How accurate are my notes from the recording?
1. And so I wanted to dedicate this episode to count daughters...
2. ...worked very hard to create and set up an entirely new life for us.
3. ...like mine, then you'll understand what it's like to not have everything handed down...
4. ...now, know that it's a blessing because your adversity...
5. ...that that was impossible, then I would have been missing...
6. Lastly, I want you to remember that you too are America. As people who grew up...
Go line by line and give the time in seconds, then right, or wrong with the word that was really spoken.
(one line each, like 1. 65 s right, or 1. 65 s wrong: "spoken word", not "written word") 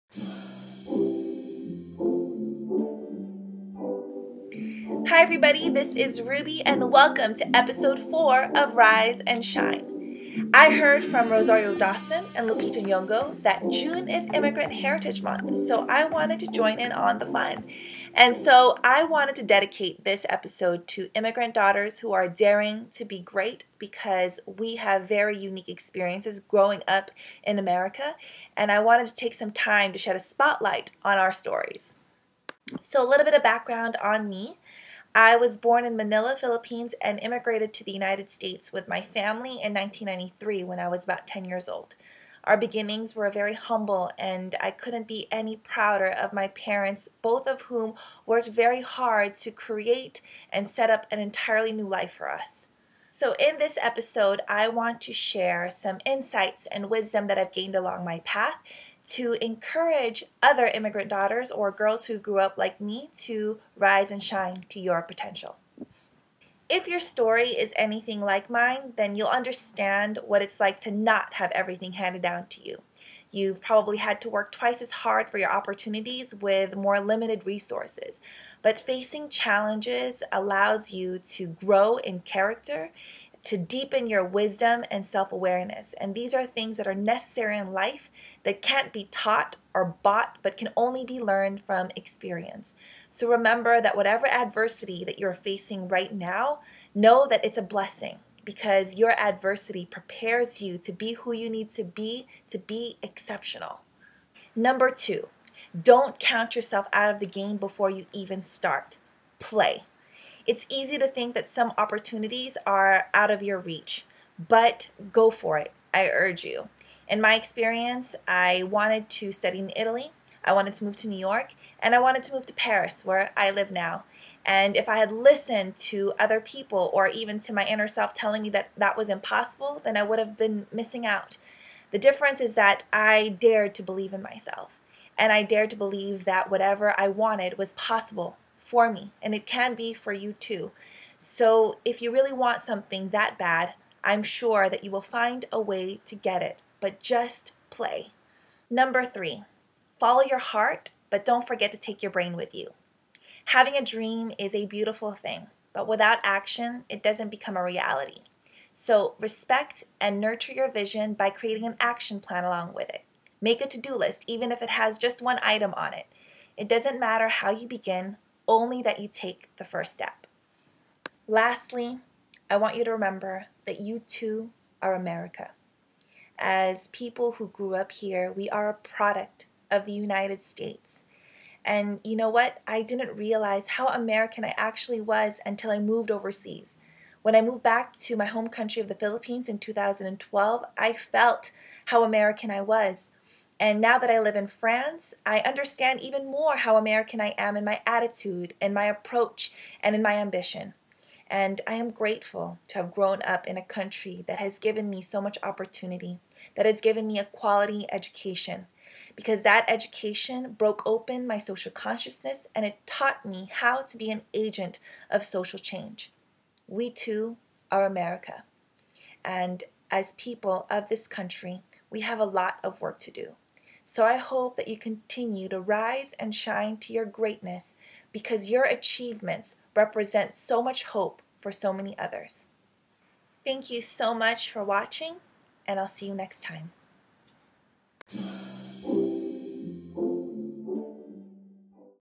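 1. 18 s wrong: "immigrant", not "count"
2. 48 s right
3. 68 s right
4. 96 s right
5. 128 s right
6. 171 s right.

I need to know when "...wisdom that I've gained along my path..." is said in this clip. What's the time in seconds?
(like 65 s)
56 s.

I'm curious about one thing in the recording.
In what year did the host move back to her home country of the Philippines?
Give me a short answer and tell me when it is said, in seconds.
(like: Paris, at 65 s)
2012, at 189 s.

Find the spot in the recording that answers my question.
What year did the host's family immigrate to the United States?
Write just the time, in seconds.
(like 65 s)
39 s.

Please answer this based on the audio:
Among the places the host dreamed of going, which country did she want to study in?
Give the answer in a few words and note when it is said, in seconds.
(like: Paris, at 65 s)
Italy, at 119 s.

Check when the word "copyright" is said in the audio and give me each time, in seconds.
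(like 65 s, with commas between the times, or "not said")
not said.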